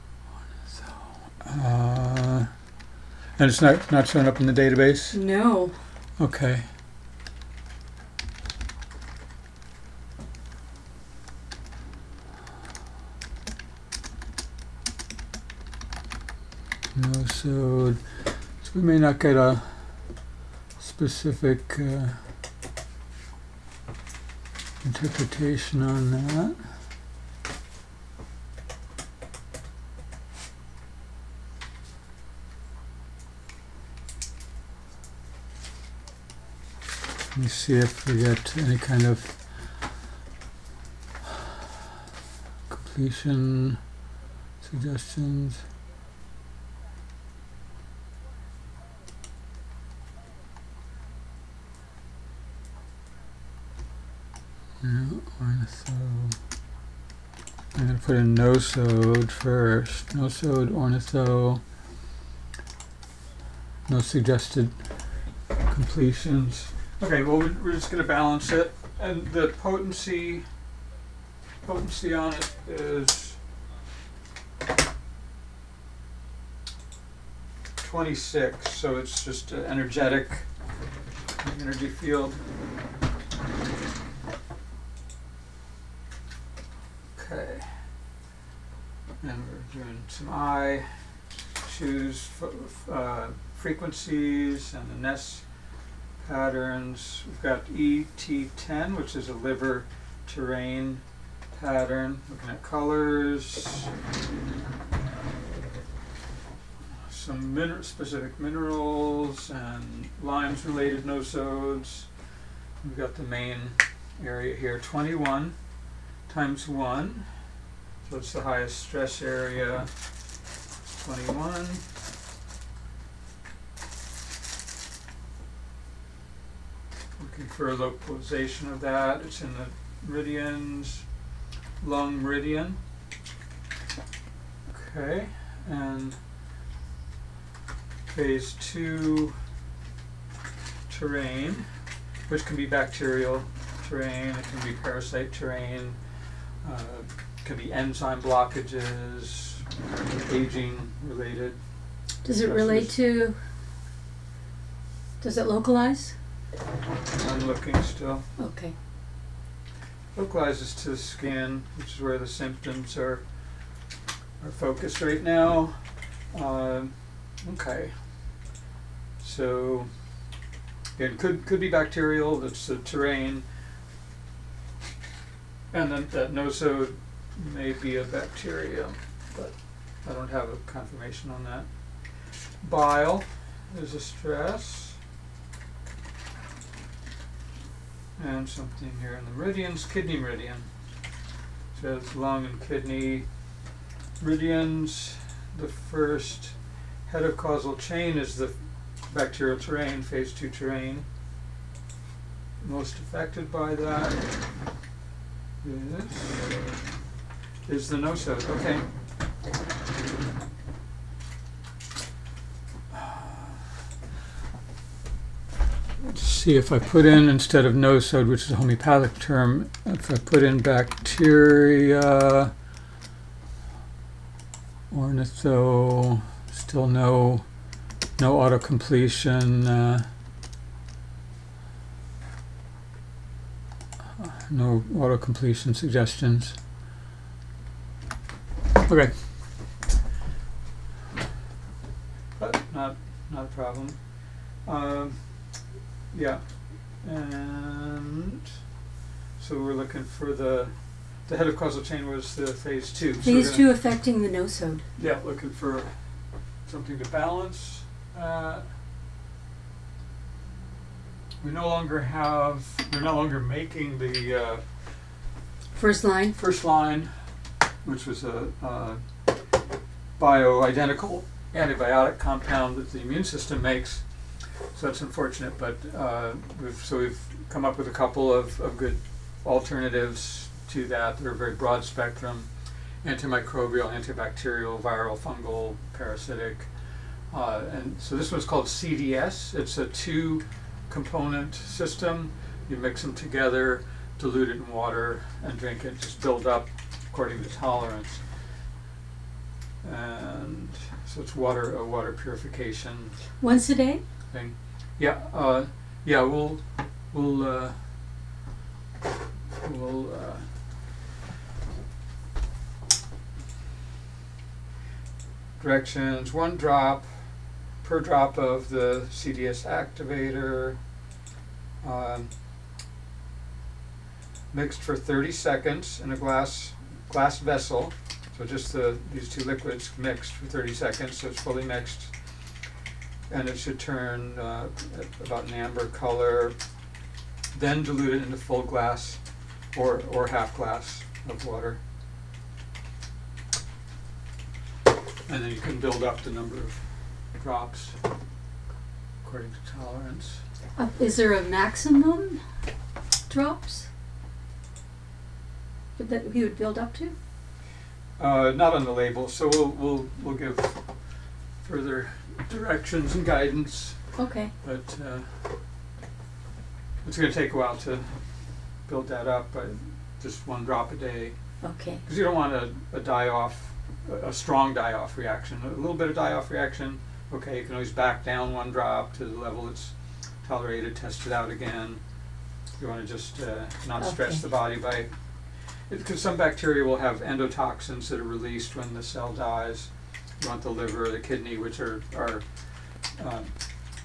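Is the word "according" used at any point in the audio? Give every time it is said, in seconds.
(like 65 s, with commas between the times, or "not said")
297 s, 349 s.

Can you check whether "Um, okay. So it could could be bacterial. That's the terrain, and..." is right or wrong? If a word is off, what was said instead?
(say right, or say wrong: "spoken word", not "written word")
right.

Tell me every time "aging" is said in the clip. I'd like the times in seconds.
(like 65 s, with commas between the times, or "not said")
150 s.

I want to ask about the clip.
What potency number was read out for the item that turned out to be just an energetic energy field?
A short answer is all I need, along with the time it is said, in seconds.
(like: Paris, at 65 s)
26, at 77 s.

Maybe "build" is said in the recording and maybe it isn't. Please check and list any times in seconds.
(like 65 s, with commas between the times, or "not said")
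296 s, 345 s, 356 s, 368 s.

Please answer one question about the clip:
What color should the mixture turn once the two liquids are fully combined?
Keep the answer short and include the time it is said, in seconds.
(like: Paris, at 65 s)
Amber, at 335 s.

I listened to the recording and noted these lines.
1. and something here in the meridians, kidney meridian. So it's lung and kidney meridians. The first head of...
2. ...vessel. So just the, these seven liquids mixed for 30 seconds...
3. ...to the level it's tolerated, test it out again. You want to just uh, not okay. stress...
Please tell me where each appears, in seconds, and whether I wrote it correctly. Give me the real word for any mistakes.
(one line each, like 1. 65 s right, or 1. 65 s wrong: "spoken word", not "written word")
1. 188 s right
2. 327 s wrong: "two", not "seven"
3. 379 s right.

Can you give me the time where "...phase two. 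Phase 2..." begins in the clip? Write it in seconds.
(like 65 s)
252 s.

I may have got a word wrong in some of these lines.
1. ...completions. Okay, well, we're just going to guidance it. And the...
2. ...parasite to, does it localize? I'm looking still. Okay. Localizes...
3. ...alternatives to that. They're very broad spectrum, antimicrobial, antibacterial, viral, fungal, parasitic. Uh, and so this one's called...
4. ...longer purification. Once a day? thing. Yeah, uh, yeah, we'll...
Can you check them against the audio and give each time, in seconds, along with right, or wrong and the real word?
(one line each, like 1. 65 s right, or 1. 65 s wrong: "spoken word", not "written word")
1. 65 s wrong: "balance", not "guidance"
2. 152 s wrong: "relate", not "parasite"
3. 279 s right
4. 301 s wrong: "water", not "longer".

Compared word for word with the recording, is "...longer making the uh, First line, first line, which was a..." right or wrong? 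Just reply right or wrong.
right.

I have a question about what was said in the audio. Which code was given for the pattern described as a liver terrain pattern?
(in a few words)
ET10.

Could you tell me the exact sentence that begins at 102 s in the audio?
Looking at colors, some min specific minerals and Lyme's related nosodes.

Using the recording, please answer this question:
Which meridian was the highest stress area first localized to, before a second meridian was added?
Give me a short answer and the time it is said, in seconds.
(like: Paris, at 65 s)
Lung meridian, at 131 s.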